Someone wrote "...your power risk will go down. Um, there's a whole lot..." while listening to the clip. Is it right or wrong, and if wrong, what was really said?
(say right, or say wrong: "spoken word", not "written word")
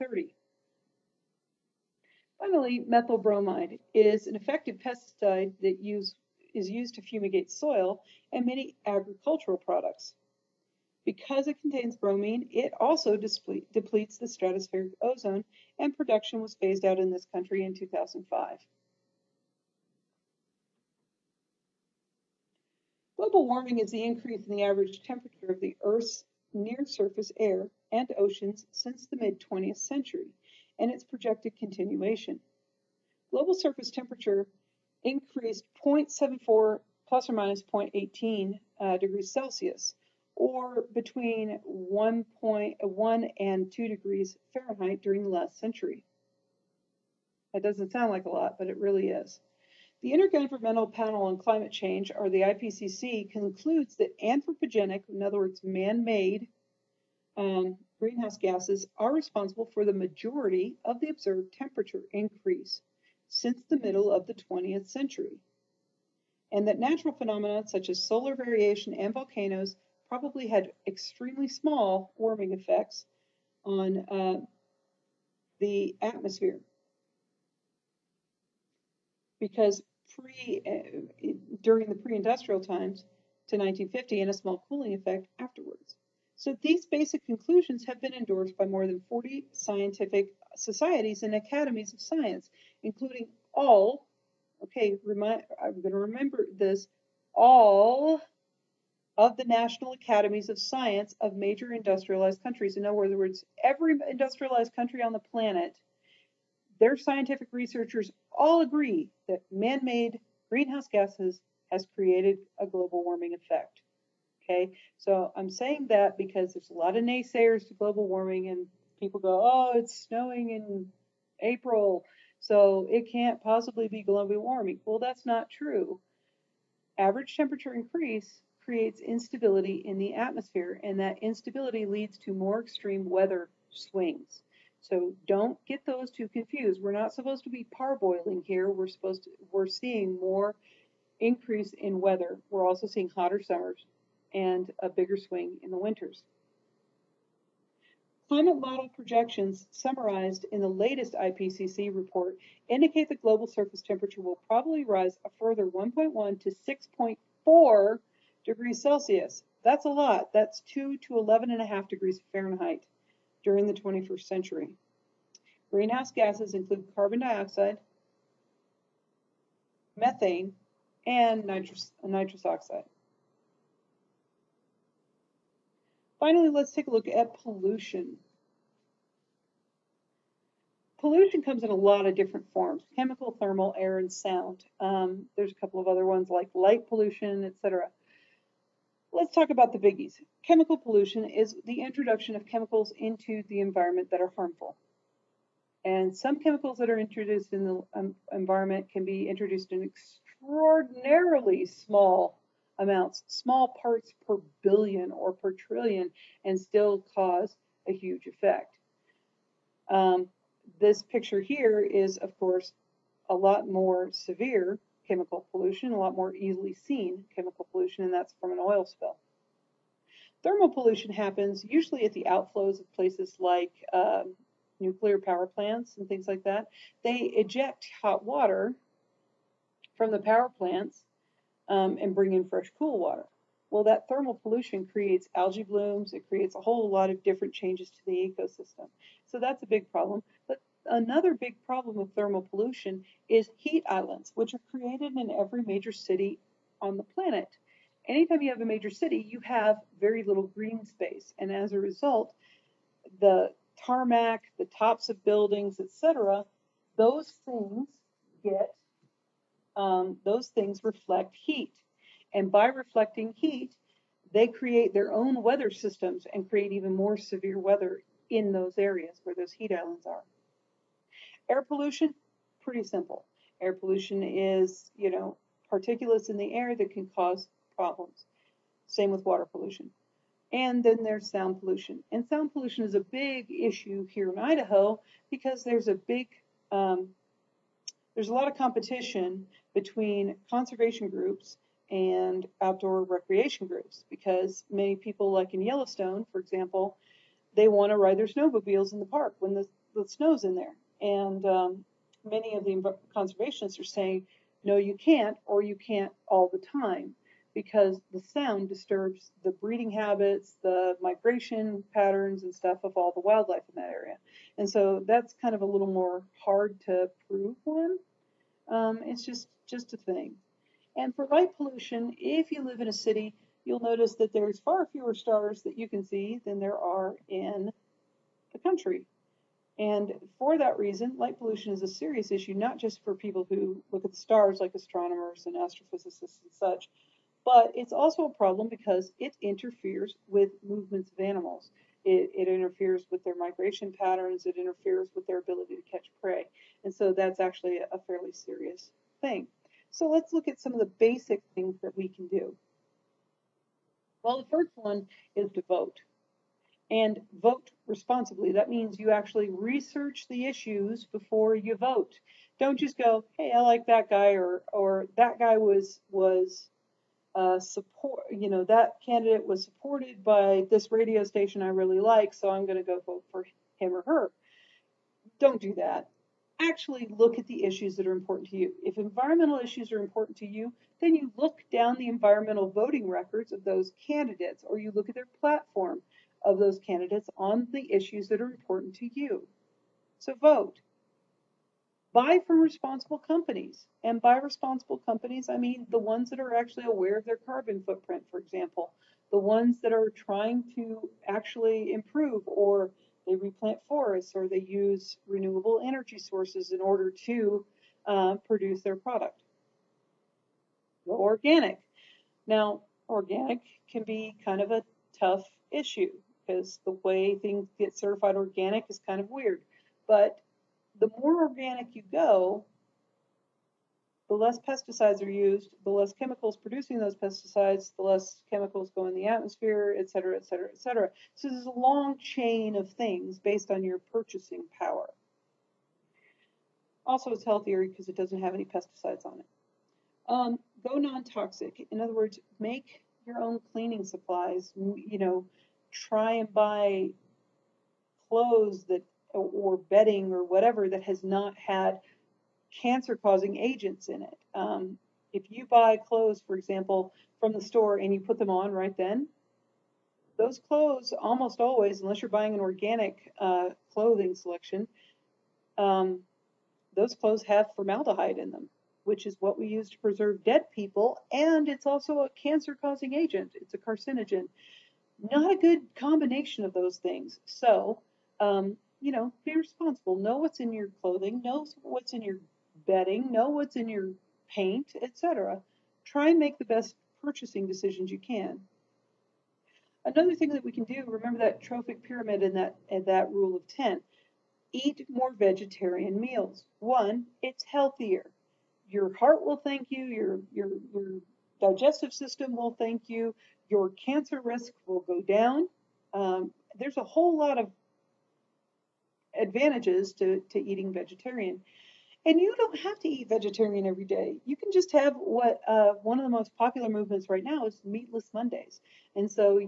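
wrong: "cancer", not "power".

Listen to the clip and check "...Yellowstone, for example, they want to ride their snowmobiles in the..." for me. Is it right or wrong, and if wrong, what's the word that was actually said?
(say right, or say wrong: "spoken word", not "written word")
right.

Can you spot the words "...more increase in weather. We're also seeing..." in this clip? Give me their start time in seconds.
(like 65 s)
140 s.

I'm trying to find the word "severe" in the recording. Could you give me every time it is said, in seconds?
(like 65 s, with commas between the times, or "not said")
214 s, 267 s.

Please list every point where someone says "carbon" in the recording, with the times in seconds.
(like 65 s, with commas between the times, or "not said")
166 s, 397 s.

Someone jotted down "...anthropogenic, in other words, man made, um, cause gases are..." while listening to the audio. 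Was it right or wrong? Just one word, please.
wrong.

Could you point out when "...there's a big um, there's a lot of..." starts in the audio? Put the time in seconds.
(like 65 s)
285 s.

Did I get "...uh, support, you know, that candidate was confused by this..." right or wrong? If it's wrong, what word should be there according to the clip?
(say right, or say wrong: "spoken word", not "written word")
wrong: "supported", not "confused".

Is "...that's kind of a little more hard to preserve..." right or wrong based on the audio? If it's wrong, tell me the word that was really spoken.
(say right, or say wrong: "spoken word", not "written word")
wrong: "prove", not "preserve".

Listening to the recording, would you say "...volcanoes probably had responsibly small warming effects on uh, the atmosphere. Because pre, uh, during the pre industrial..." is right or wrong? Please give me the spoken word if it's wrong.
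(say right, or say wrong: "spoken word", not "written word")
wrong: "extremely", not "responsibly".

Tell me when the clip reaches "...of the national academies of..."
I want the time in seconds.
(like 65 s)
99 s.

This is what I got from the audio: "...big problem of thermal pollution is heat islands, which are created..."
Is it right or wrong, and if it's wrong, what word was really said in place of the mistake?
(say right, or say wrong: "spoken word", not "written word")
right.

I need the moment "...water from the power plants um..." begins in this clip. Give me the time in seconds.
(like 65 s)
228 s.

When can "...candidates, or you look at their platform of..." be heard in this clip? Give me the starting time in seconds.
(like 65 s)
384 s.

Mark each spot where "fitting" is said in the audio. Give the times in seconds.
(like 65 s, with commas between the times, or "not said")
not said.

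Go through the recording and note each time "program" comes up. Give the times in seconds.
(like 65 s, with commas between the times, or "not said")
not said.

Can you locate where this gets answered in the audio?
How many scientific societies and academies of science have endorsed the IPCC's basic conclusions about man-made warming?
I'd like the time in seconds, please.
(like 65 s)
88 s.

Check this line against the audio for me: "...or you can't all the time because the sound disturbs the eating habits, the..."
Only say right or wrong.
wrong.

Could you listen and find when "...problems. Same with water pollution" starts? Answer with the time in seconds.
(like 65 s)
277 s.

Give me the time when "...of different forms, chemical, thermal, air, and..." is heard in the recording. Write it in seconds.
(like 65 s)
182 s.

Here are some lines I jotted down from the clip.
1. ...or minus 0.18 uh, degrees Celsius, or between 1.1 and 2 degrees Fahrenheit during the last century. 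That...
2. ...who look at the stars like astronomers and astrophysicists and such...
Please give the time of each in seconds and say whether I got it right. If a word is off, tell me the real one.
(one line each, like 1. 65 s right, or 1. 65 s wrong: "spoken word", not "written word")
1. 37 s right
2. 333 s right.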